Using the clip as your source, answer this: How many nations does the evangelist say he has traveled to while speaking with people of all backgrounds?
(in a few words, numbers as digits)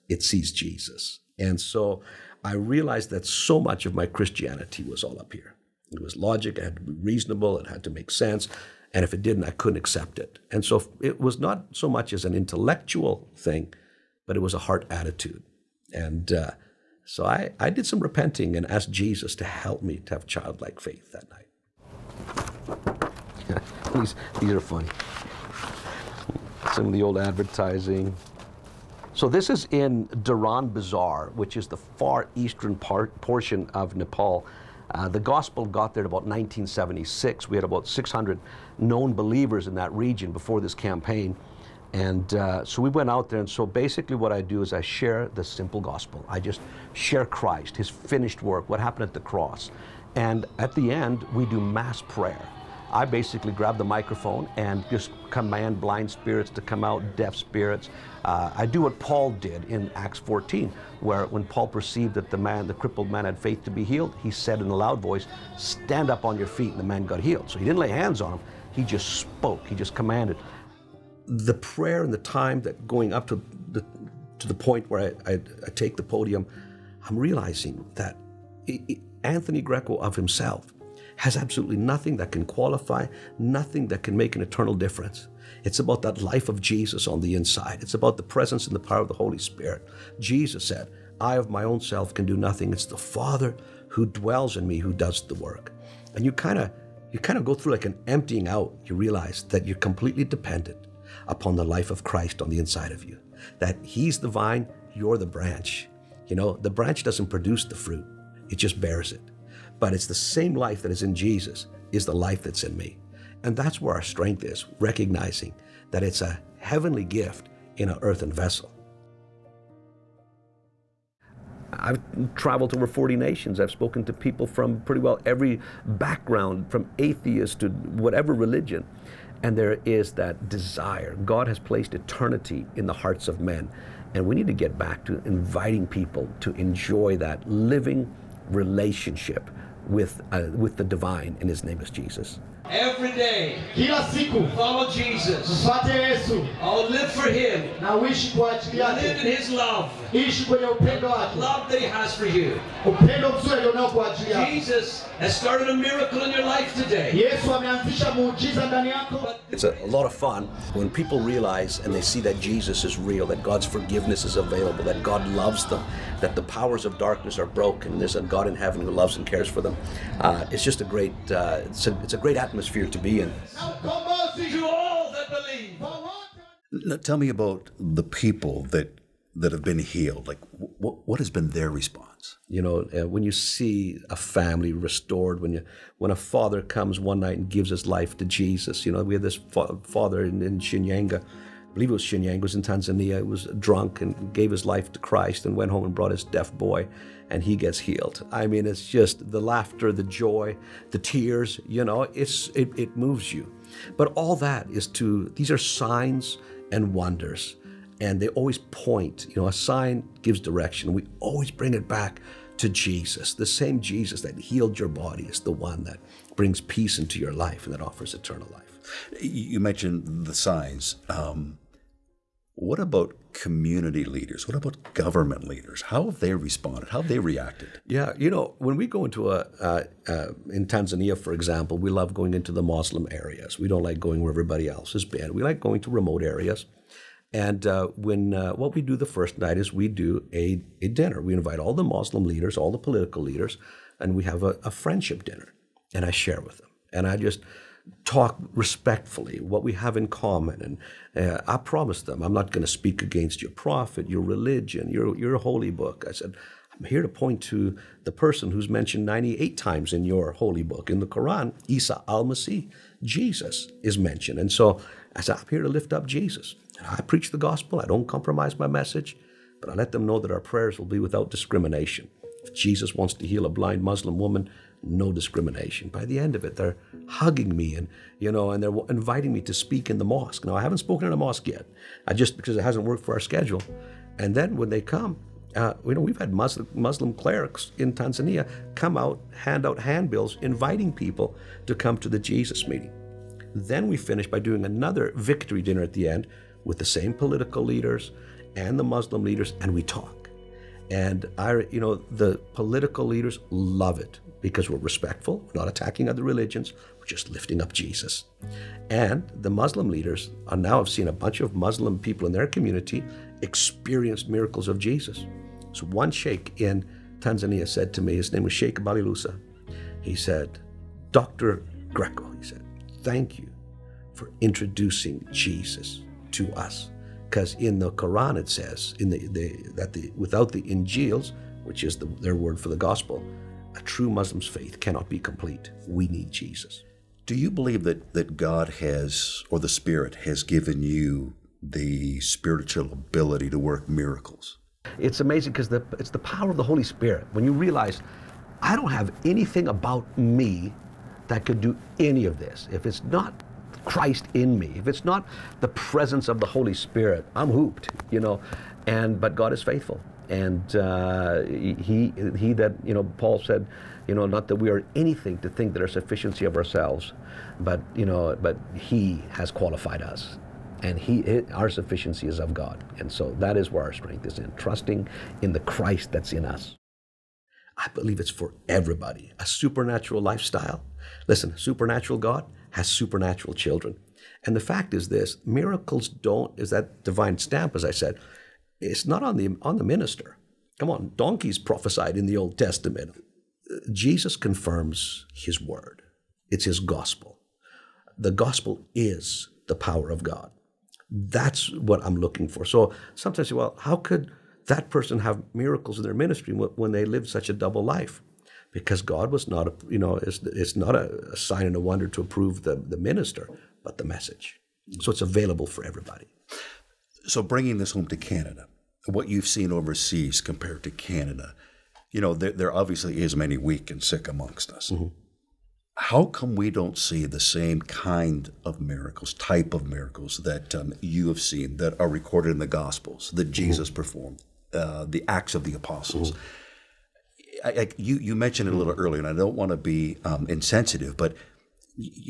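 over 40.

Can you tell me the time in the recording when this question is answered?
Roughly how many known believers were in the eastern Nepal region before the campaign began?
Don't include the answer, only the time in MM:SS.
00:37.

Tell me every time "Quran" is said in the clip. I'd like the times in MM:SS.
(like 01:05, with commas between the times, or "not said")
04:21, 05:27.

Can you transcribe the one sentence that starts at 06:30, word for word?
Come on, donkeys prophesied in the Old Testament.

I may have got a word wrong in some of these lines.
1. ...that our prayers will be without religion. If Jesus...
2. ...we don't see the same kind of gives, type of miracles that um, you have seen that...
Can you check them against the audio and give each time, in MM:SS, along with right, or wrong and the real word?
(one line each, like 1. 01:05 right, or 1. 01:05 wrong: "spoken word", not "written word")
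1. 04:30 wrong: "discrimination", not "religion"
2. 07:06 wrong: "miracles", not "gives".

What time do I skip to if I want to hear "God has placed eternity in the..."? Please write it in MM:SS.
02:11.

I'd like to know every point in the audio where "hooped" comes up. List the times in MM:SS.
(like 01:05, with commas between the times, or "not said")
05:57.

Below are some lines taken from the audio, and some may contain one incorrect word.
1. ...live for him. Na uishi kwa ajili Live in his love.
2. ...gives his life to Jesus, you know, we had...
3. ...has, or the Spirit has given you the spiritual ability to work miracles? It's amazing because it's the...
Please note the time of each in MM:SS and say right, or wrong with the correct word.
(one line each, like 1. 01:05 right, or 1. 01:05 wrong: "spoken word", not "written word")
1. 02:26 right
2. 03:07 right
3. 05:38 right.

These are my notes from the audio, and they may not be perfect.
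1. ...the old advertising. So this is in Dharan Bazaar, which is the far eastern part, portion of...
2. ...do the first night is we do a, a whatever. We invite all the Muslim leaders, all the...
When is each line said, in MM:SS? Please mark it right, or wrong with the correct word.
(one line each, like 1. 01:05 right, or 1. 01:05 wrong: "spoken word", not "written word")
1. 00:26 right
2. 03:58 wrong: "dinner", not "whatever".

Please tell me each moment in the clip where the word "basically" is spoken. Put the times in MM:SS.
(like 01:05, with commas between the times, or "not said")
00:43, 00:53.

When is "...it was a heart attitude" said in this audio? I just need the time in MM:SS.
00:14.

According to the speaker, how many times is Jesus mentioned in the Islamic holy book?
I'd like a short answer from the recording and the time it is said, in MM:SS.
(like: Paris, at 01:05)
98, at 04:19.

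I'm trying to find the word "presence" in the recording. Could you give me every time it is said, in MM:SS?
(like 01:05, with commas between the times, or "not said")
01:28, 05:55.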